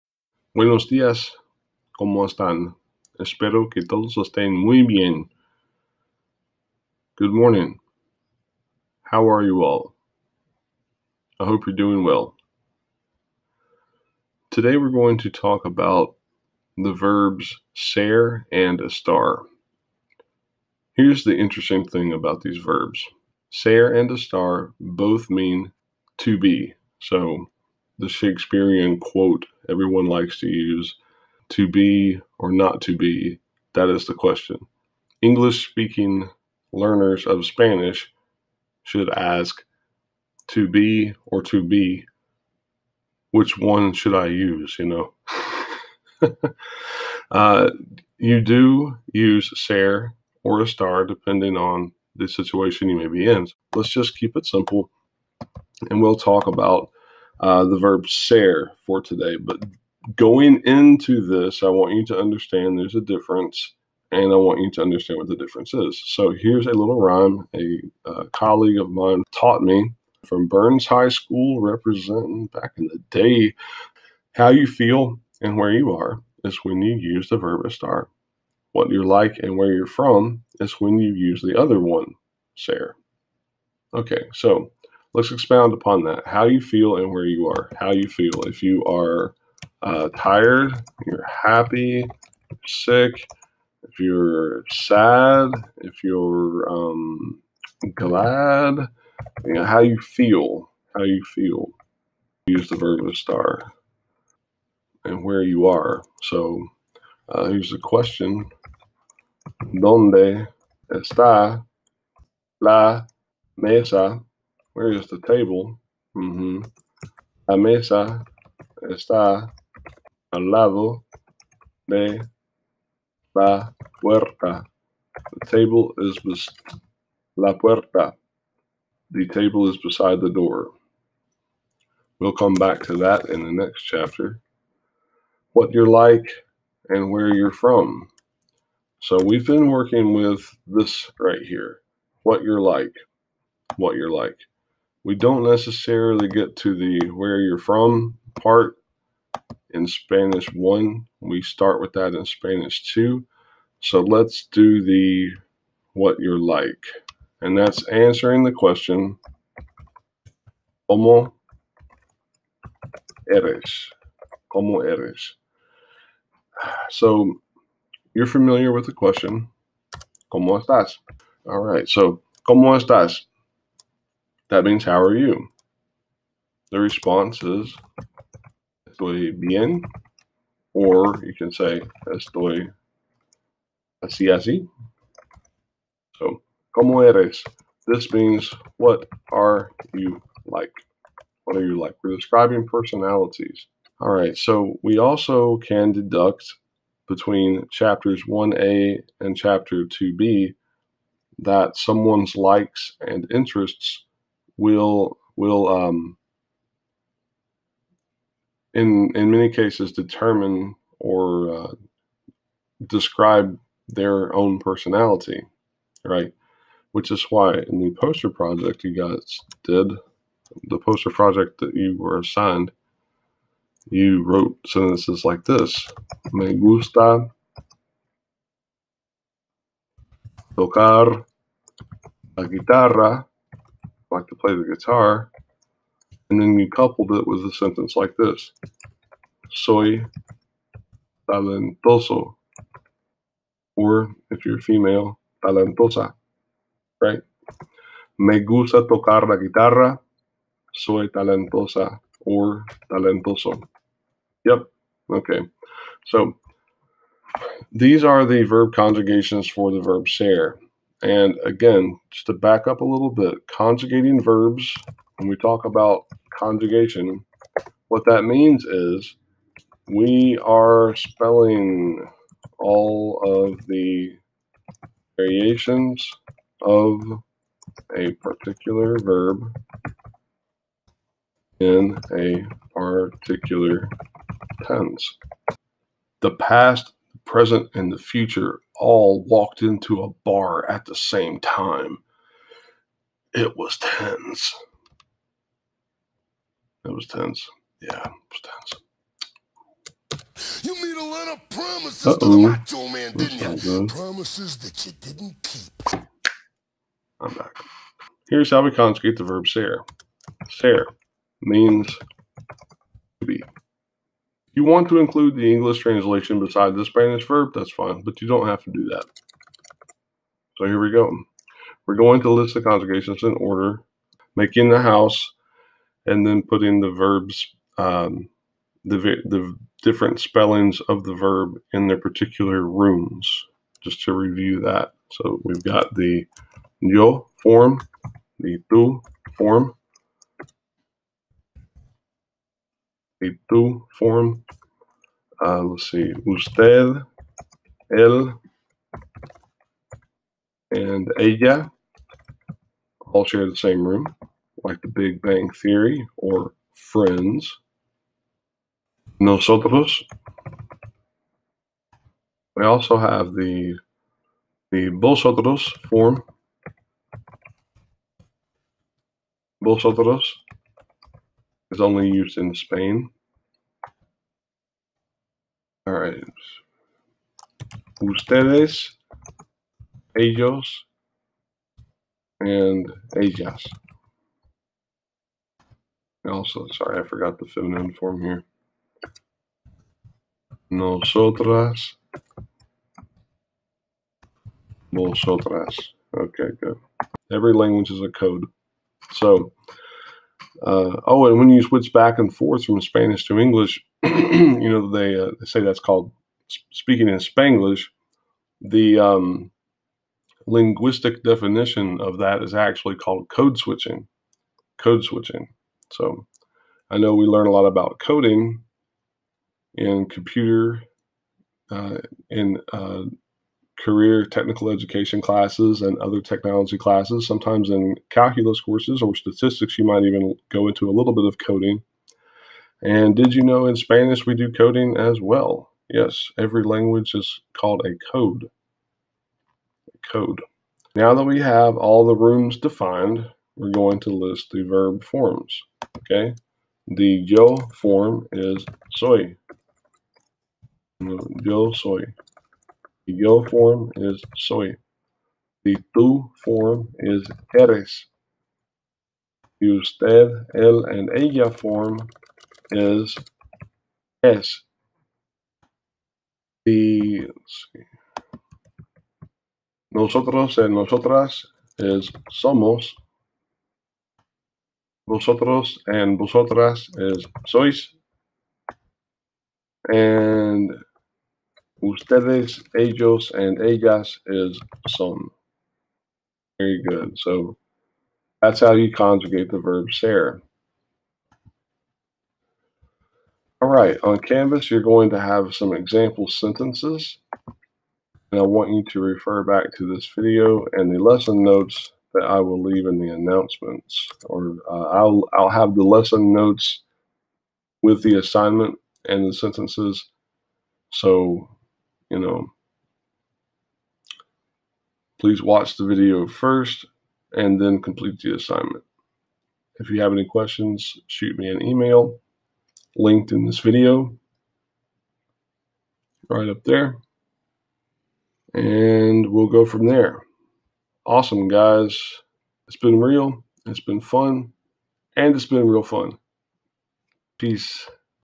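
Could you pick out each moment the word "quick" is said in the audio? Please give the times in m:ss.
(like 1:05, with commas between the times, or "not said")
not said.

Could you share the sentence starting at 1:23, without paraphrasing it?
Okay, so let's expound upon that.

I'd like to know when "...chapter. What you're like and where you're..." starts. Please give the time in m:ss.
2:13.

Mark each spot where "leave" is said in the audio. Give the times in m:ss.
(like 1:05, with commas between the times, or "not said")
8:22.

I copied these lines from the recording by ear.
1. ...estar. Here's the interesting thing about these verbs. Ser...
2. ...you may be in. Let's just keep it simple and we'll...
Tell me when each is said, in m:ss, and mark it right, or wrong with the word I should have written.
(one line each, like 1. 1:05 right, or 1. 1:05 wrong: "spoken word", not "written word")
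1. 0:18 right
2. 0:52 right.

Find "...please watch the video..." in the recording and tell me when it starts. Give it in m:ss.
8:35.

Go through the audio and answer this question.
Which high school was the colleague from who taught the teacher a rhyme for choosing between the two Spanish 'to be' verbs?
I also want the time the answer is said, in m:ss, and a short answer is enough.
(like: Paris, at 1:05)
Burns High School, at 1:10.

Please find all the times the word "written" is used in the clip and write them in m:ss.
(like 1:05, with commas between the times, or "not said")
not said.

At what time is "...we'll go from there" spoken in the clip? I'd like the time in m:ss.
8:49.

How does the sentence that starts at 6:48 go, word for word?
The um, linguistic definition of that is actually called code switching.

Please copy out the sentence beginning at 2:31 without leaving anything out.
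We start with that in Spanish 2.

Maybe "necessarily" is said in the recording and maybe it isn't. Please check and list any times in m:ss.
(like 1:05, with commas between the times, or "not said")
2:25.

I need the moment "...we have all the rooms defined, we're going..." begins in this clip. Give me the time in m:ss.
7:21.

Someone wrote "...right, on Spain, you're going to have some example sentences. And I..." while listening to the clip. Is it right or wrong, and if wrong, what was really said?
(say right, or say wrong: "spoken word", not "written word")
wrong: "Canvas", not "Spain".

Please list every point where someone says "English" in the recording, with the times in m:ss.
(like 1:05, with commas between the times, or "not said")
0:35, 5:15, 6:43.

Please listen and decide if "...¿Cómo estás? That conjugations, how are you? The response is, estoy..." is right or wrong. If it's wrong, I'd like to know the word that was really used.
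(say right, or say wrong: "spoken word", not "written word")
wrong: "means", not "conjugations".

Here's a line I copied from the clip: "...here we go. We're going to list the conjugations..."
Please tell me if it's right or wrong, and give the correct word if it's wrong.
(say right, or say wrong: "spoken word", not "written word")
right.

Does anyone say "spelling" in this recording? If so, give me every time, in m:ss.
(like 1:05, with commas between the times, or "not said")
4:30, 5:30.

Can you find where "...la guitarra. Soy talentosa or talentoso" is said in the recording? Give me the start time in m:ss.
4:09.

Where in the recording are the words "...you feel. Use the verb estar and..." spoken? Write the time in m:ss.
1:41.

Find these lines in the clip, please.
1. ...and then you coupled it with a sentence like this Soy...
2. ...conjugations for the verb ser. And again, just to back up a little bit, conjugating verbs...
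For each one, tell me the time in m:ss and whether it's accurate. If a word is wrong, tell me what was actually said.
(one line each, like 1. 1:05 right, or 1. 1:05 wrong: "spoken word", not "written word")
1. 3:56 right
2. 4:18 right.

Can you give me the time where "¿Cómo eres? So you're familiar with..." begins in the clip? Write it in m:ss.
2:44.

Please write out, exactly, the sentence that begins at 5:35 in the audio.
So we've got the yo form, the tu form, y tú form.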